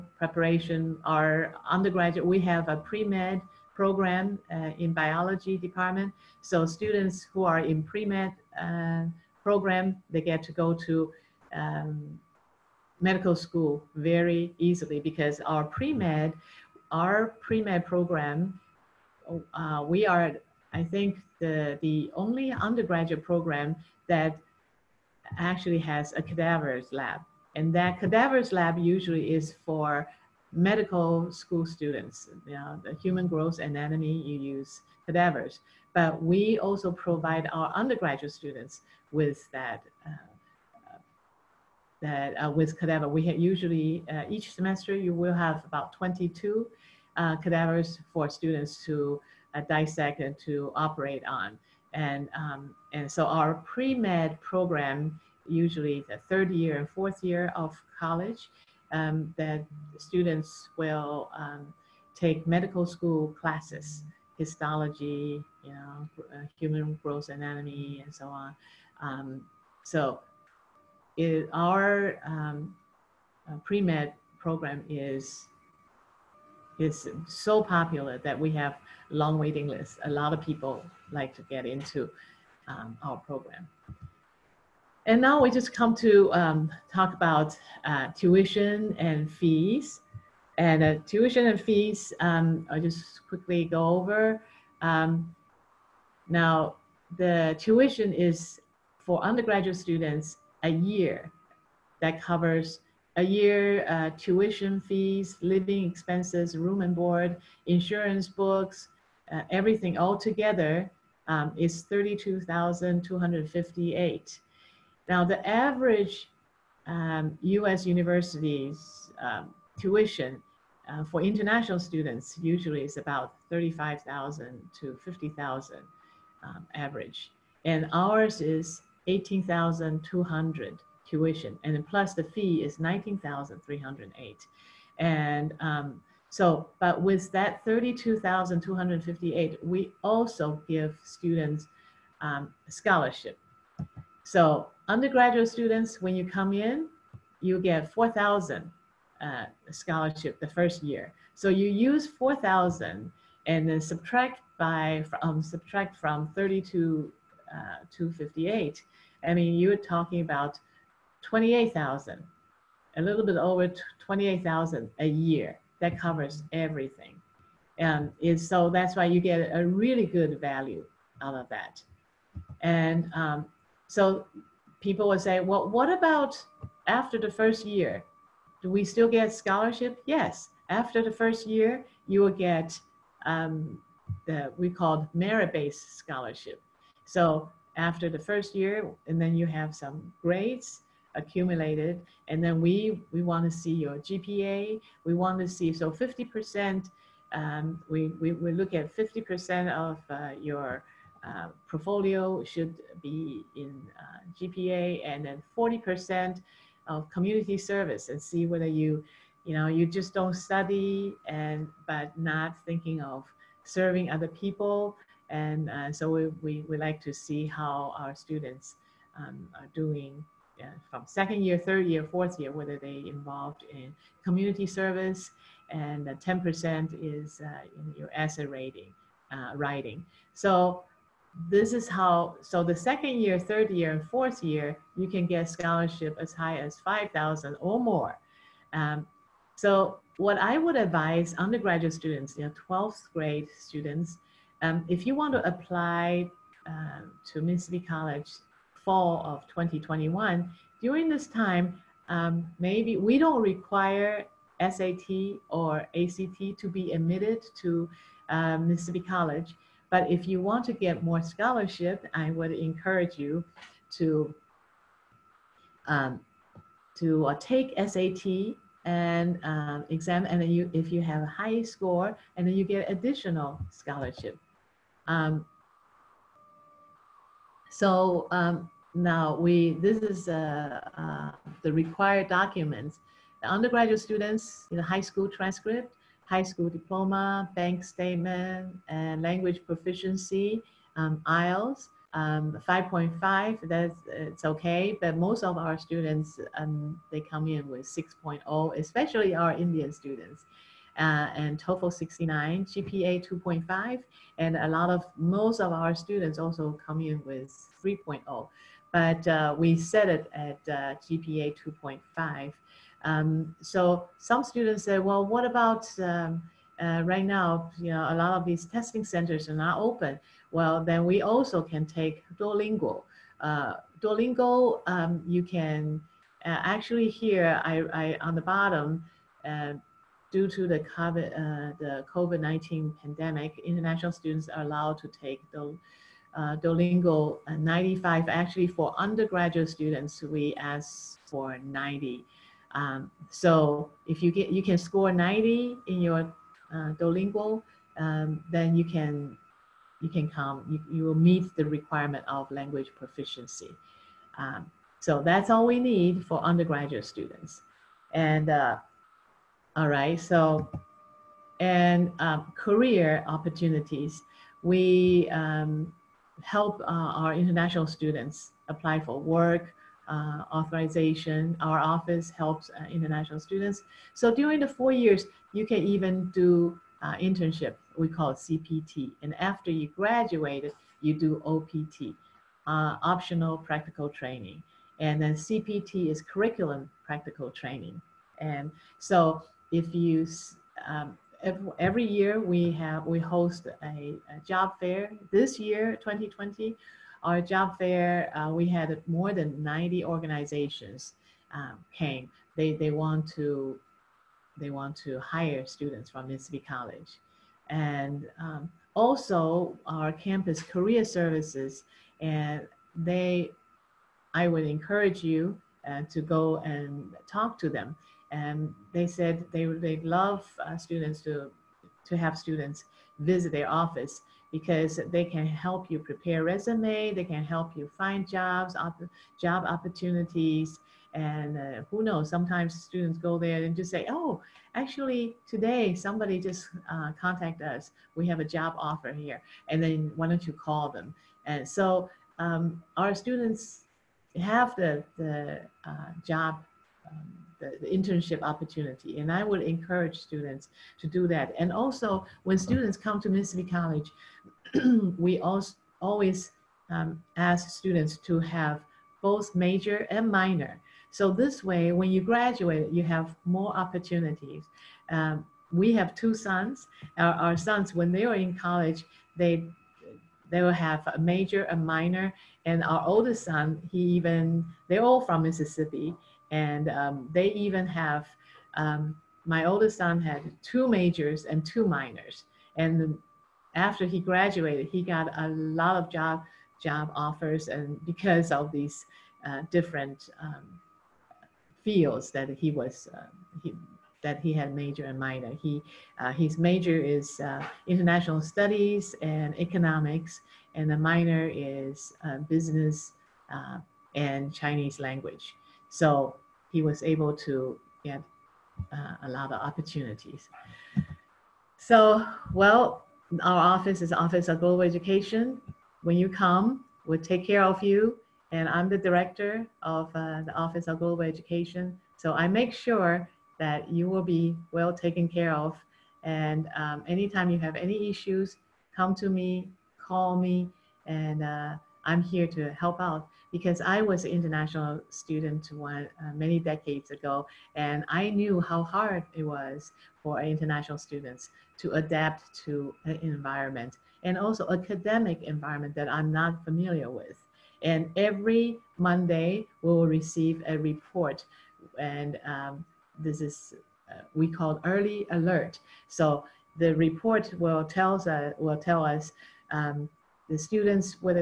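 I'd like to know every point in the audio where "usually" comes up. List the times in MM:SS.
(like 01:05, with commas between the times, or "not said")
00:28, 00:43, 00:55, 02:02.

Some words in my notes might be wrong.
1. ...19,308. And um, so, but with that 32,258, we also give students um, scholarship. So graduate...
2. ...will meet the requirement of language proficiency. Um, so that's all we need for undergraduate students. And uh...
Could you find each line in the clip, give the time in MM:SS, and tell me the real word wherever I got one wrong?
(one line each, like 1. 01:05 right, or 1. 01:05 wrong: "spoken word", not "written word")
1. 02:12 wrong: "undergraduate", not "graduate"
2. 05:51 right.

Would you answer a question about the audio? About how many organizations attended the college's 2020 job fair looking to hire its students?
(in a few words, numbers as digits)
more than 90.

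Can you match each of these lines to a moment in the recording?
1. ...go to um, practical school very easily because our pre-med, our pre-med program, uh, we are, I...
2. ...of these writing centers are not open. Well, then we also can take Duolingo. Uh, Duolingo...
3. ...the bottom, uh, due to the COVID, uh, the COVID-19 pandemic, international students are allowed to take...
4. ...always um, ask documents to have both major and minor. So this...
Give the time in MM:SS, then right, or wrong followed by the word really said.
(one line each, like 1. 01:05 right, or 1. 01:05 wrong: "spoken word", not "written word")
1. 00:10 wrong: "medical", not "practical"
2. 05:18 wrong: "testing", not "writing"
3. 05:28 right
4. 07:36 wrong: "students", not "documents".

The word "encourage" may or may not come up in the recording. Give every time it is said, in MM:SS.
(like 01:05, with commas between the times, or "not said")
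04:22, 06:54, 07:29.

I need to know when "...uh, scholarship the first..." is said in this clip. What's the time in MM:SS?
02:29.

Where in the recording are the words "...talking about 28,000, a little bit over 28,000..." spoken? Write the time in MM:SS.
02:39.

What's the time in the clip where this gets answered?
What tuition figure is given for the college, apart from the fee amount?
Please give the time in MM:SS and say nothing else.
02:09.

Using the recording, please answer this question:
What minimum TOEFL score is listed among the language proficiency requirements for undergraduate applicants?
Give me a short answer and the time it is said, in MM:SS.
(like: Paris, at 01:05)
69, at 05:01.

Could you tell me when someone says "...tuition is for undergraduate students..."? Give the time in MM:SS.
01:37.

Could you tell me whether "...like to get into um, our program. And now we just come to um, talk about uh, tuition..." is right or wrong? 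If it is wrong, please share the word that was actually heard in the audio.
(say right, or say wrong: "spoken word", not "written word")
right.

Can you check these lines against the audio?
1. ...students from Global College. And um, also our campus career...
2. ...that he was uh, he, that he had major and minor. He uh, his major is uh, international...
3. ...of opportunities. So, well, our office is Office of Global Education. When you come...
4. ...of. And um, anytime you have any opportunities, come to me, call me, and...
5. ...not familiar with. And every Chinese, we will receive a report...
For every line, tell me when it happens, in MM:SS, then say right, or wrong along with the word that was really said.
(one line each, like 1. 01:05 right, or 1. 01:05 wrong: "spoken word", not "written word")
1. 06:45 wrong: "Mississippi", not "Global"
2. 08:12 right
3. 08:29 right
4. 08:45 wrong: "issues", not "opportunities"
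5. 09:06 wrong: "Monday", not "Chinese".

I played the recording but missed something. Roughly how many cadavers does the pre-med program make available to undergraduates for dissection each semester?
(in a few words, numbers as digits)
22.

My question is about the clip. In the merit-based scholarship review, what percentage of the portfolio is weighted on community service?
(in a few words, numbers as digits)
40%.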